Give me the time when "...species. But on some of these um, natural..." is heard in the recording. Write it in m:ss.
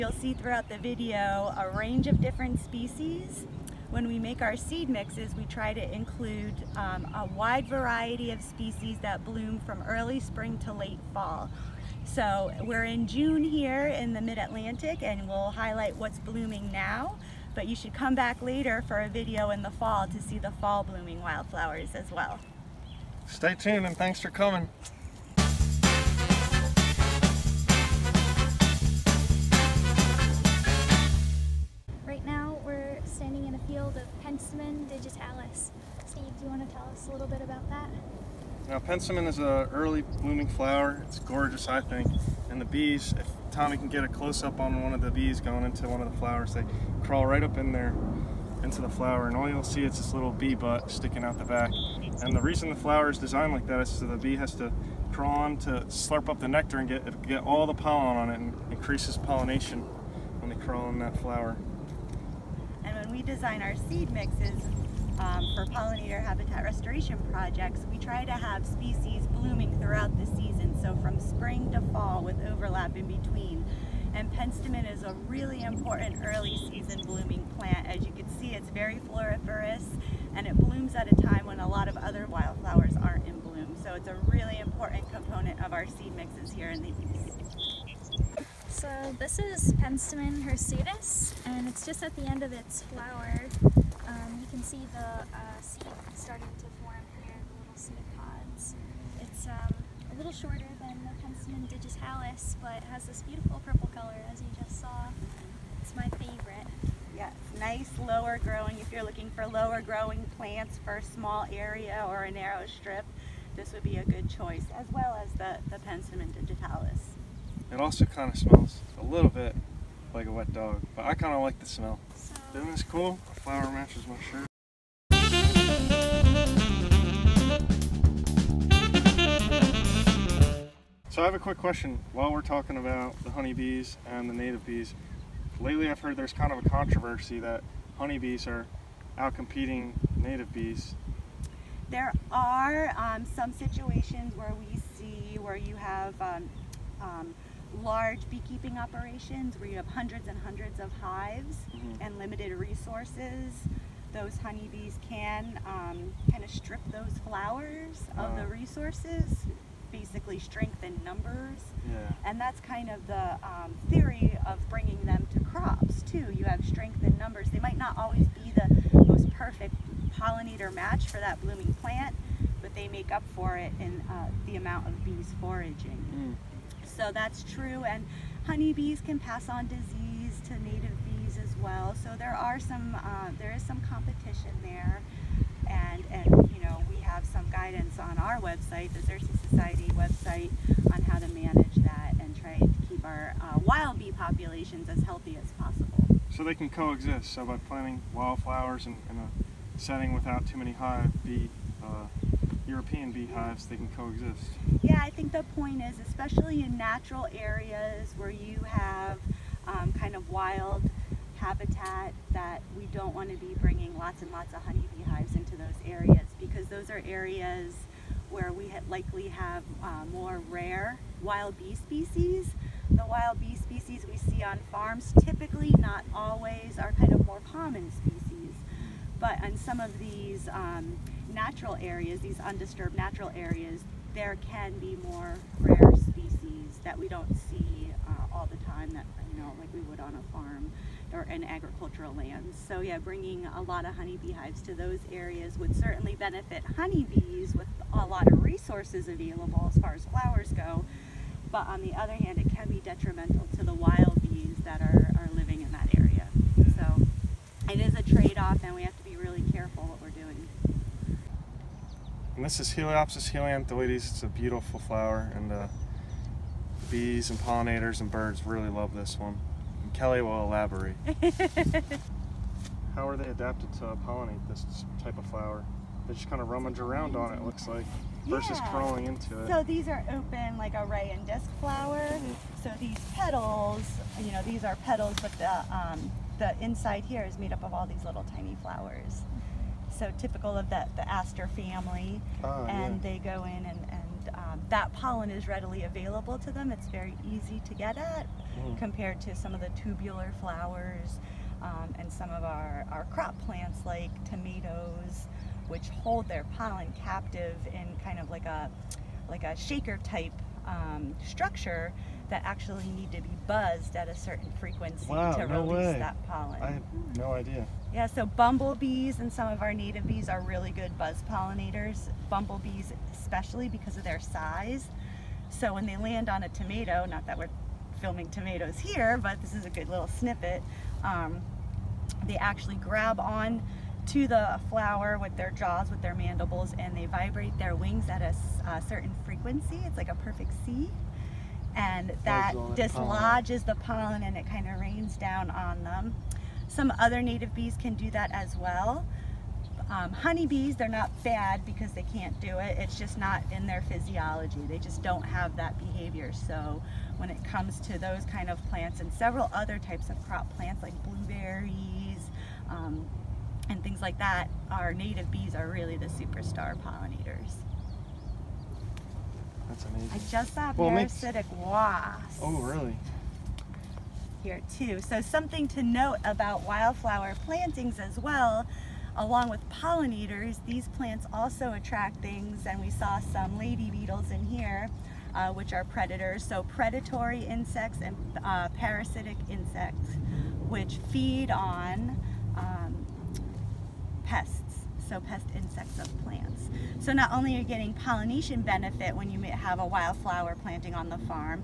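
3:47.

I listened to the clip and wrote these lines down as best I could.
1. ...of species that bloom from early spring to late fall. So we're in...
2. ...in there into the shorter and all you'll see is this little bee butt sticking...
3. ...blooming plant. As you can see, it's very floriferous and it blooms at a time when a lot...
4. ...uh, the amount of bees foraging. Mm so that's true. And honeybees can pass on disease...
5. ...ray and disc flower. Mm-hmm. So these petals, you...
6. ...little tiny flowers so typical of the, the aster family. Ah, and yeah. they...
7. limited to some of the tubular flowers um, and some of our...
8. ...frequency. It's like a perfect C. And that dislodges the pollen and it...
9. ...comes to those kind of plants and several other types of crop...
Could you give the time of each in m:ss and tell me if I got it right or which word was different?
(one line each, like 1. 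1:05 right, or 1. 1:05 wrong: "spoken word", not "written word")
1. 0:08 right
2. 0:47 wrong: "flower", not "shorter"
3. 1:17 right
4. 2:54 right
5. 4:40 right
6. 4:48 right
7. 4:58 wrong: "compared", not "limited"
8. 5:39 right
9. 5:57 right.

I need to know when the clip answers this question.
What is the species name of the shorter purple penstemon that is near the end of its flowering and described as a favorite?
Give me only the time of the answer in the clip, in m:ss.
1:29.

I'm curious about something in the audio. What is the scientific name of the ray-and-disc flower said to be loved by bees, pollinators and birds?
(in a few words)
Heliopsis helianthoides.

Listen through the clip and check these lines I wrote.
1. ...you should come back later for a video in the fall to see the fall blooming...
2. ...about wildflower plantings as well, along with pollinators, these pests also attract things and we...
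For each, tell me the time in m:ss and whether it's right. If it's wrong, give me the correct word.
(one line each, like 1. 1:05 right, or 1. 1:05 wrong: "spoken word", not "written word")
1. 0:17 right
2. 6:16 wrong: "plants", not "pests".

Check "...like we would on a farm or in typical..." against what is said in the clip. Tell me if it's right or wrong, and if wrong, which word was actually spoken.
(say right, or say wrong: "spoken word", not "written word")
wrong: "agricultural", not "typical".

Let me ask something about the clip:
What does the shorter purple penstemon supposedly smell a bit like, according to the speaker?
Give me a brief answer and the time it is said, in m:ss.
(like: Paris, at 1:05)
A wet dog, at 2:00.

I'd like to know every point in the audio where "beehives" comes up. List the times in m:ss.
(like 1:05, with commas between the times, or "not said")
3:23, 3:34.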